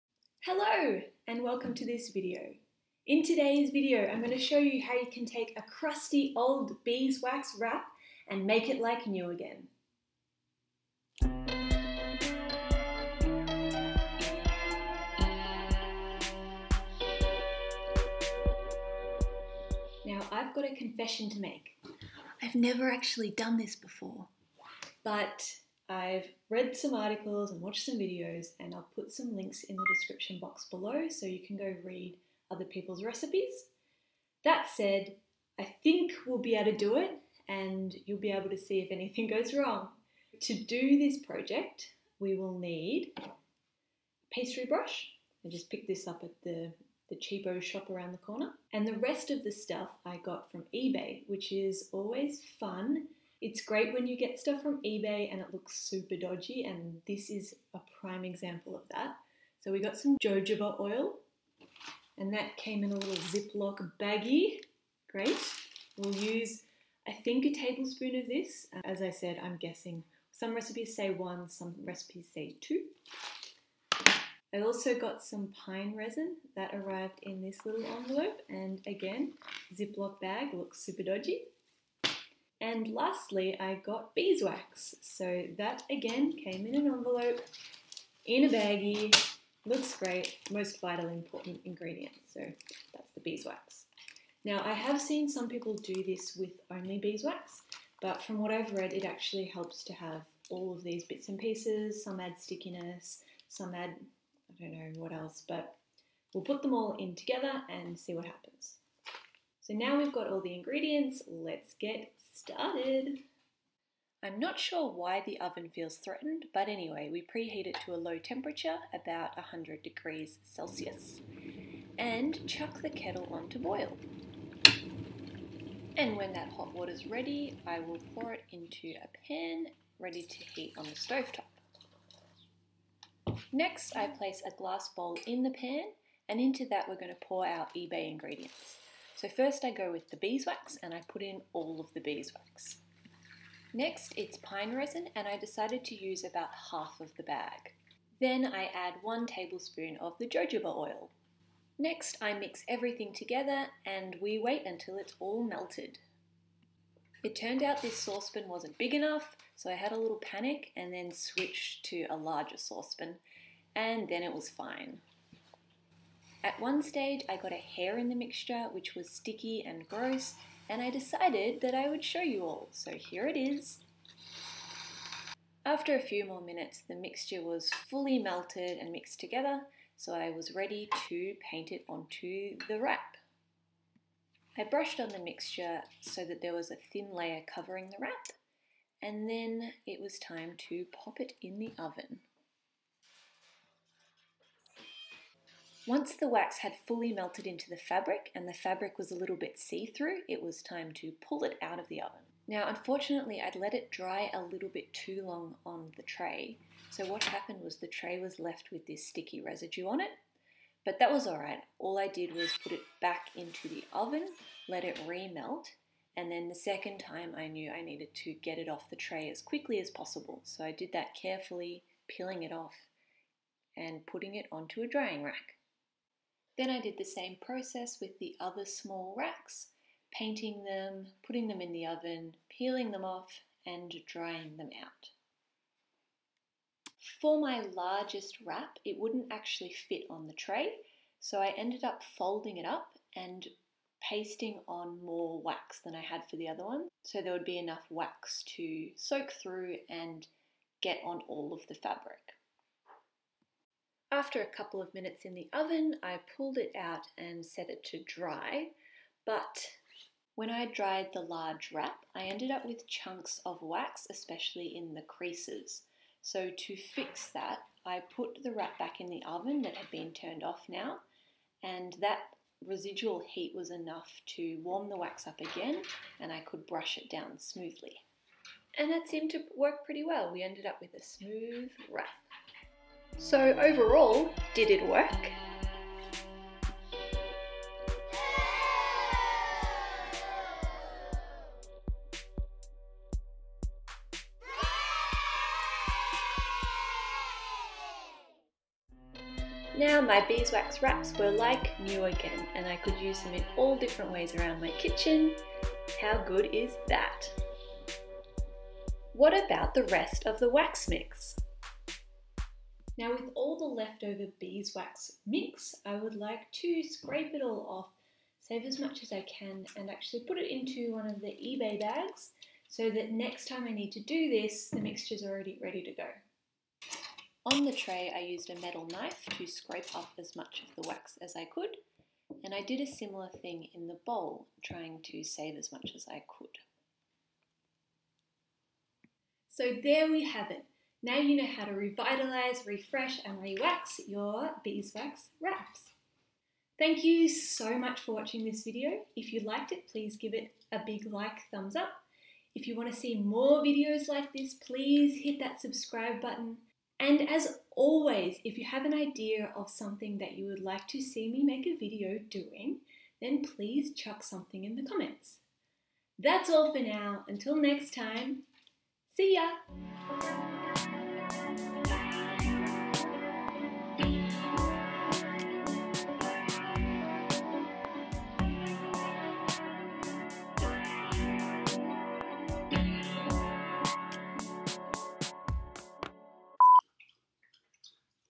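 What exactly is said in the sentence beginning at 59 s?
So we got some jojoba oil, and that came in a little Ziploc baggie.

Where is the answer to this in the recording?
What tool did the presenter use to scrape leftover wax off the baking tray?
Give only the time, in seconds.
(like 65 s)
328 s.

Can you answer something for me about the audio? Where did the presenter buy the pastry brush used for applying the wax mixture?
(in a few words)
The cheapo shop around the corner.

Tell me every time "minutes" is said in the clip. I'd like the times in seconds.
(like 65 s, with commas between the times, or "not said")
176 s, 254 s.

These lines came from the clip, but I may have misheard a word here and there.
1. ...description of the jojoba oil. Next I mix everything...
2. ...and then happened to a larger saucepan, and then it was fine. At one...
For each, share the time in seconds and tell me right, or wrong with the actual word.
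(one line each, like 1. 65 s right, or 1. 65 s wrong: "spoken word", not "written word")
1. 149 s wrong: "tablespoon", not "description"
2. 160 s wrong: "switched", not "happened".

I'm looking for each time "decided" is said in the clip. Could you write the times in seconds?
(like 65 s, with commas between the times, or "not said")
145 s, 170 s.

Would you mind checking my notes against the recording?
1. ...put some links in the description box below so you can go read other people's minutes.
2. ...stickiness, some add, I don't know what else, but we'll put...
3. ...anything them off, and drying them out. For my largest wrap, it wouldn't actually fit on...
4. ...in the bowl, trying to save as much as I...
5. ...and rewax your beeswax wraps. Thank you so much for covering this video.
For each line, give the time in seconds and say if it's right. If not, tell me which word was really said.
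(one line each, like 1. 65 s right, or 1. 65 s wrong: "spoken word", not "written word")
1. 28 s wrong: "recipes", not "minutes"
2. 102 s right
3. 232 s wrong: "peeling", not "anything"
4. 333 s right
5. 343 s wrong: "watching", not "covering".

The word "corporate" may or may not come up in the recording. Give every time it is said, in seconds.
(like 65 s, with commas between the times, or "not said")
not said.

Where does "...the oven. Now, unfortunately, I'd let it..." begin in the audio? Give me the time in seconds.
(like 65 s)
201 s.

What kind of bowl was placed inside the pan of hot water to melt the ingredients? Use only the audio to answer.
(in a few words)
Glass bowl.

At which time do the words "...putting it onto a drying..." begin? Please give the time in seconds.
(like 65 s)
224 s.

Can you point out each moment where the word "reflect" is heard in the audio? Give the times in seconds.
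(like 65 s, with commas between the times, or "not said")
not said.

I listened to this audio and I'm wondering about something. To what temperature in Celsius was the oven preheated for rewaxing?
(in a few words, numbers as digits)
100 degrees.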